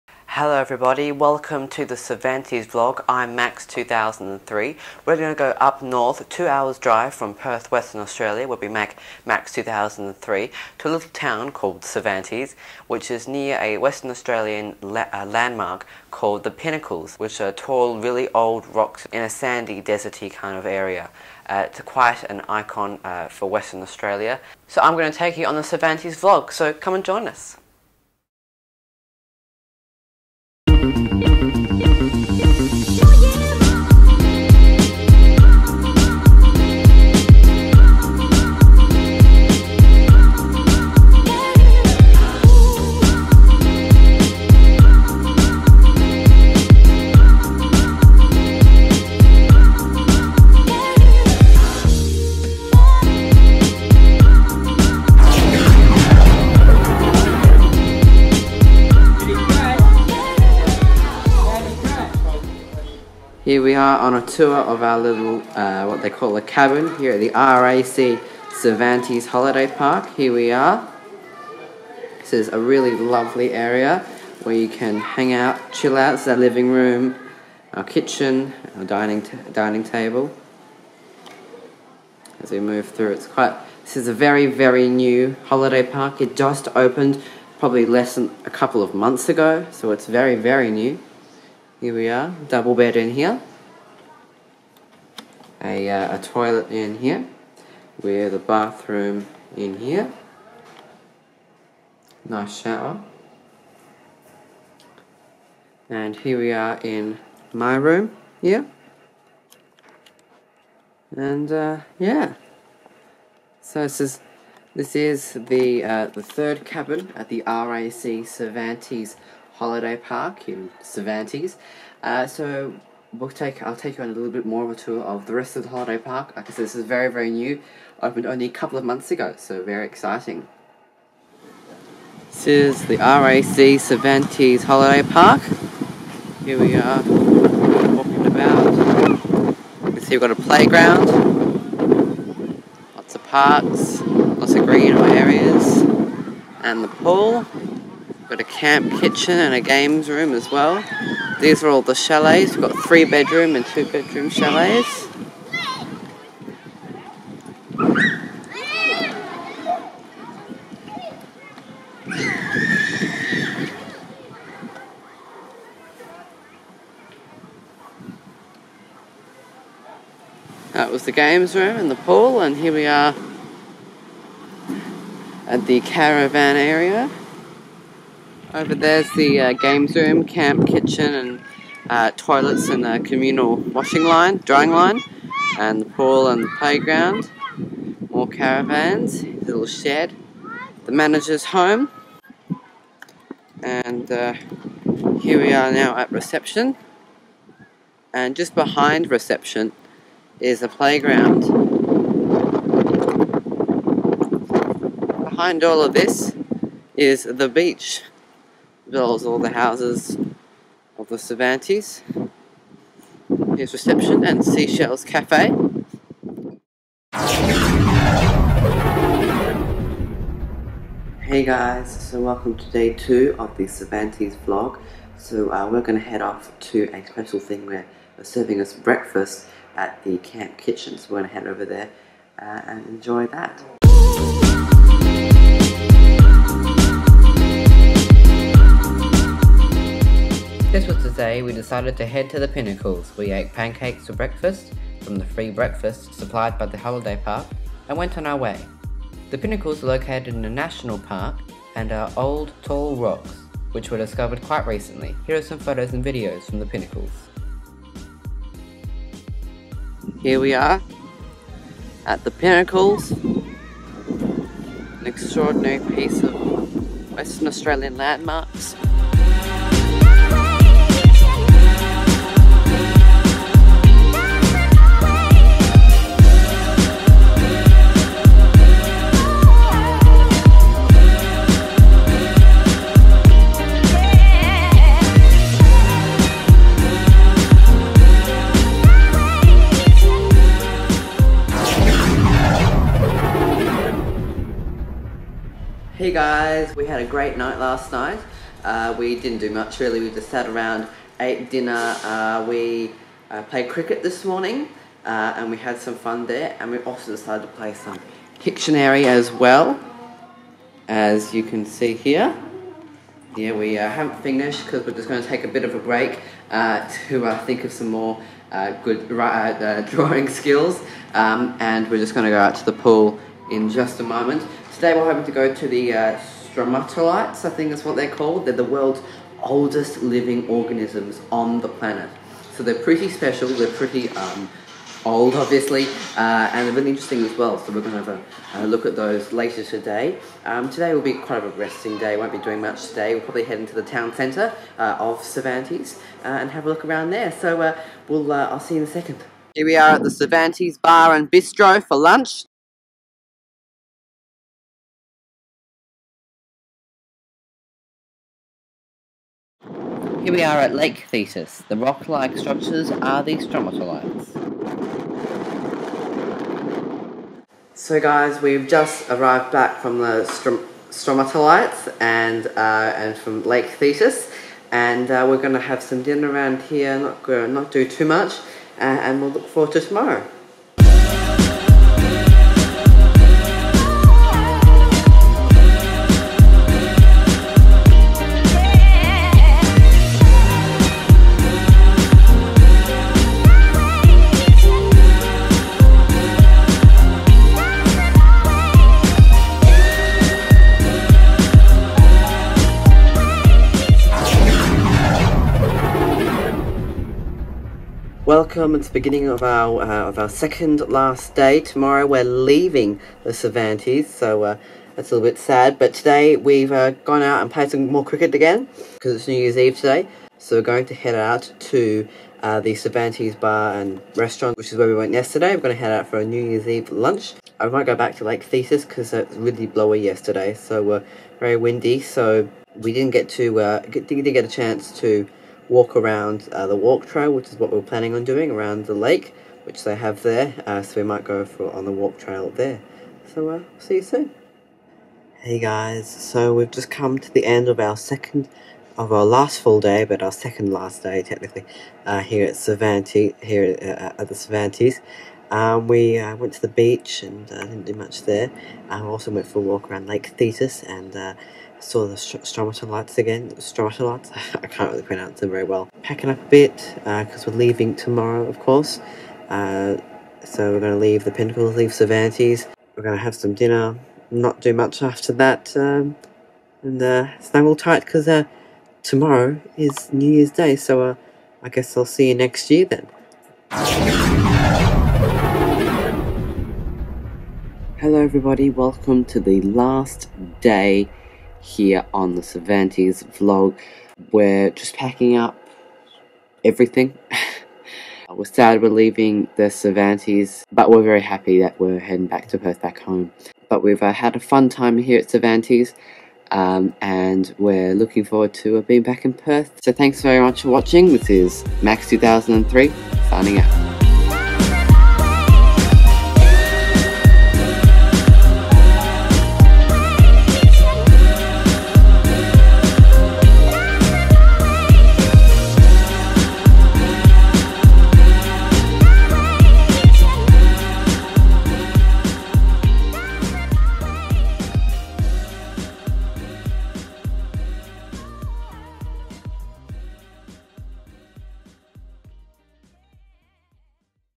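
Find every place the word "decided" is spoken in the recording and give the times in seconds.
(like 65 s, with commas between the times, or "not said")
241 s, 307 s.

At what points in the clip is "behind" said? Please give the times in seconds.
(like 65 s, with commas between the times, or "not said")
198 s, 205 s.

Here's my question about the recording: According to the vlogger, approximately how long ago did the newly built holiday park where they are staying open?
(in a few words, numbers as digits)
less than a couple of months.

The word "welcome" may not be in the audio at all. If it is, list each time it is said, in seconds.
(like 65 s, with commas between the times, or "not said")
1 s, 222 s, 408 s, 488 s.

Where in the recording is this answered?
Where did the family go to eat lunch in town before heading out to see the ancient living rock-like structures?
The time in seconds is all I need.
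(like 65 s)
350 s.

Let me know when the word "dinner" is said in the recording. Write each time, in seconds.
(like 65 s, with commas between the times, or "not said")
301 s, 376 s, 473 s.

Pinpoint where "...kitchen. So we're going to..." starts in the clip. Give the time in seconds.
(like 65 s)
230 s.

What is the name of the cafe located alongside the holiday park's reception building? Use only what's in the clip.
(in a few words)
Seashells Cafe.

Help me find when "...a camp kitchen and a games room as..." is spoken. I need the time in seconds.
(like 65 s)
148 s.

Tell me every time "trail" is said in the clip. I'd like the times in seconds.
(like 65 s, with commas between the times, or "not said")
437 s, 442 s.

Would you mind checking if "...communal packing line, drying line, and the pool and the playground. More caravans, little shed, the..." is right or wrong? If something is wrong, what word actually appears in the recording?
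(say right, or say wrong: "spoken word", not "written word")
wrong: "washing", not "packing".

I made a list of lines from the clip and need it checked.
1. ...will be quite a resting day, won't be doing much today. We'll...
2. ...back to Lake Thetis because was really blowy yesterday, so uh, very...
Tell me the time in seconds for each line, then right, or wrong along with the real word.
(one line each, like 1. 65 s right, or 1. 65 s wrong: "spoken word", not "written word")
1. 340 s right
2. 427 s right.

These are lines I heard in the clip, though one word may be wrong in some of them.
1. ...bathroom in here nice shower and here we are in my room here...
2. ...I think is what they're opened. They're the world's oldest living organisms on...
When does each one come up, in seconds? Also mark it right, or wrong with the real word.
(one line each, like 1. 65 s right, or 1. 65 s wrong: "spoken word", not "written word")
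1. 98 s right
2. 327 s wrong: "called", not "opened".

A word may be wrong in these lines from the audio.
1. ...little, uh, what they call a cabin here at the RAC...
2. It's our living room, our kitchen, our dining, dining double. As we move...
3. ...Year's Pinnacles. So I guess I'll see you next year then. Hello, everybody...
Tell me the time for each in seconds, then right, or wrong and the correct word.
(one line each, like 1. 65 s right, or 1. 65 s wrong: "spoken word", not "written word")
1. 64 s right
2. 76 s wrong: "table", not "double"
3. 480 s wrong: "Day", not "Pinnacles".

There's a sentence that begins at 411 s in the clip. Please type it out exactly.
Tomorrow we're leaving the Cervantes, so uh, that's a little bit sad.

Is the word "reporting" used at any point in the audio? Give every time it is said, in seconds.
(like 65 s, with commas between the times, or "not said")
not said.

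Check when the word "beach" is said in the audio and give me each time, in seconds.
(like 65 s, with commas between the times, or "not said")
207 s, 456 s.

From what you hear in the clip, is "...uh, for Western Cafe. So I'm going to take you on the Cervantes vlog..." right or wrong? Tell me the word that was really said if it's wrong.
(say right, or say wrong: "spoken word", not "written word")
wrong: "Australia", not "Cafe".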